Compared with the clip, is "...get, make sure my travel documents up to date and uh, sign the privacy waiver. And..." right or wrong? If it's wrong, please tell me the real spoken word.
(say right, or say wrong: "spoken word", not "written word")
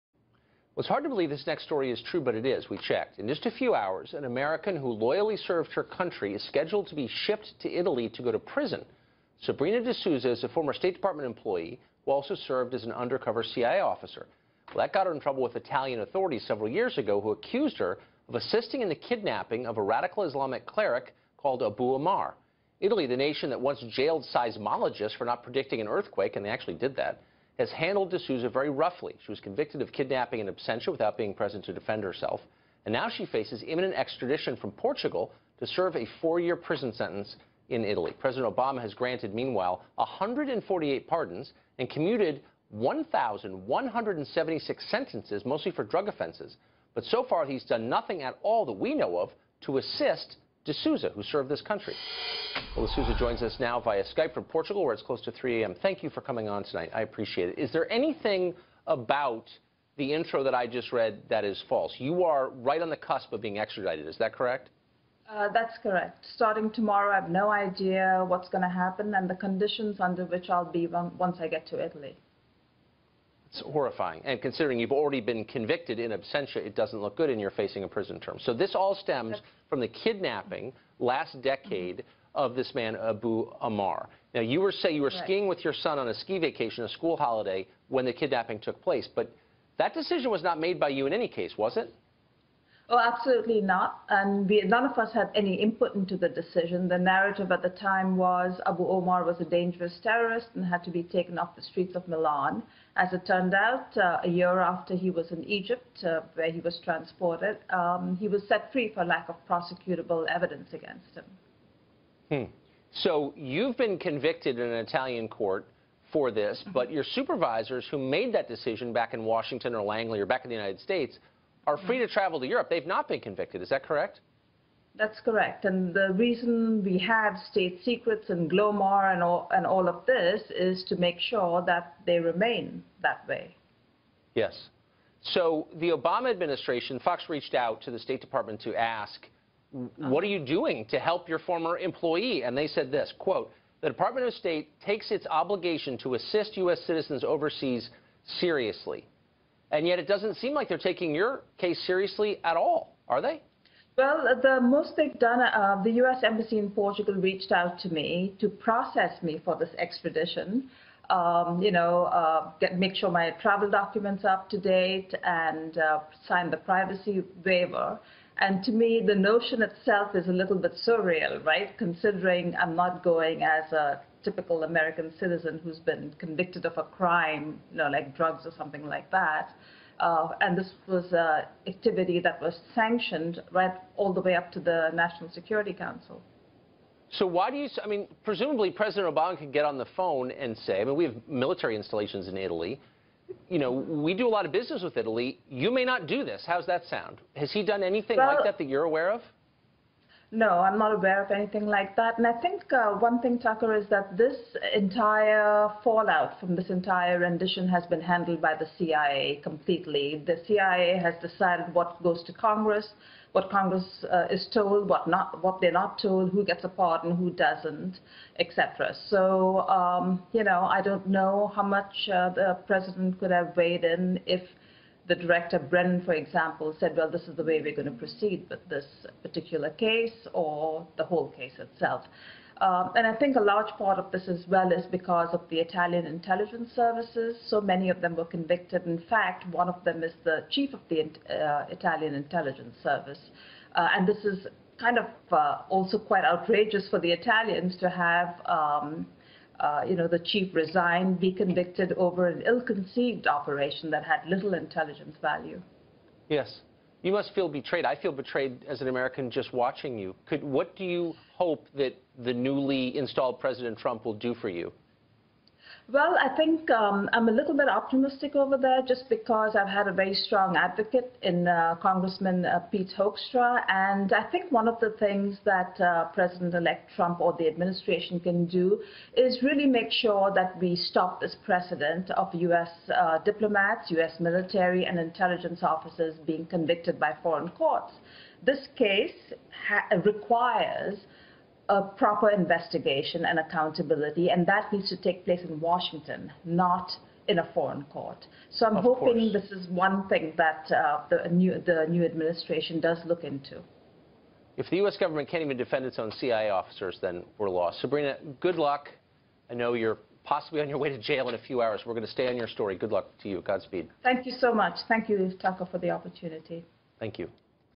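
right.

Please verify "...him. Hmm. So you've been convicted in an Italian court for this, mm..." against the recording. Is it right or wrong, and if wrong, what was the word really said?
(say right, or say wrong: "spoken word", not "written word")
right.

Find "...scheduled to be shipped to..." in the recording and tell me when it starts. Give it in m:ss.
0:06.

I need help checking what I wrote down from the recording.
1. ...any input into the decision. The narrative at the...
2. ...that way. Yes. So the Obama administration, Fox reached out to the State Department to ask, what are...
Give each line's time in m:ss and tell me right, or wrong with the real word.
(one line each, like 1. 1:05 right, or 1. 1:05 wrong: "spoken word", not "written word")
1. 1:35 right
2. 2:13 right.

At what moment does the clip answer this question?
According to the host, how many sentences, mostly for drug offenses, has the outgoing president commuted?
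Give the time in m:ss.
0:42.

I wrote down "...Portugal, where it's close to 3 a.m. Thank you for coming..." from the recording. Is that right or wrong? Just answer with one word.
right.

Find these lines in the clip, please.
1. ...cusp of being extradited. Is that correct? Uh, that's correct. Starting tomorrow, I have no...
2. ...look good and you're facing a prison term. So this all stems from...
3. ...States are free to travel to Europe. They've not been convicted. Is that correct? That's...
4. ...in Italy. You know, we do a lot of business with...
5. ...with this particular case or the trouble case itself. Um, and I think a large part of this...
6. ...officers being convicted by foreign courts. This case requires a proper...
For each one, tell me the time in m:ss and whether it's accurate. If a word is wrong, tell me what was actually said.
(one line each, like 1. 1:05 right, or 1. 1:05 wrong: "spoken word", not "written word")
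1. 1:02 right
2. 1:16 right
3. 2:00 right
4. 3:12 right
5. 3:48 wrong: "whole", not "trouble"
6. 4:45 right.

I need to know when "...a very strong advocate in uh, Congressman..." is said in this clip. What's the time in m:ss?
4:29.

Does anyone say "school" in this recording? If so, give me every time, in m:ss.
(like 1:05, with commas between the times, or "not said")
1:26.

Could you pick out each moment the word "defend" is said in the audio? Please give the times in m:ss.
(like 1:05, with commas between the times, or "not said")
0:31, 5:05.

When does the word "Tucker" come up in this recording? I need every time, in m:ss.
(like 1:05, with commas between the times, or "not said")
3:23, 5:15.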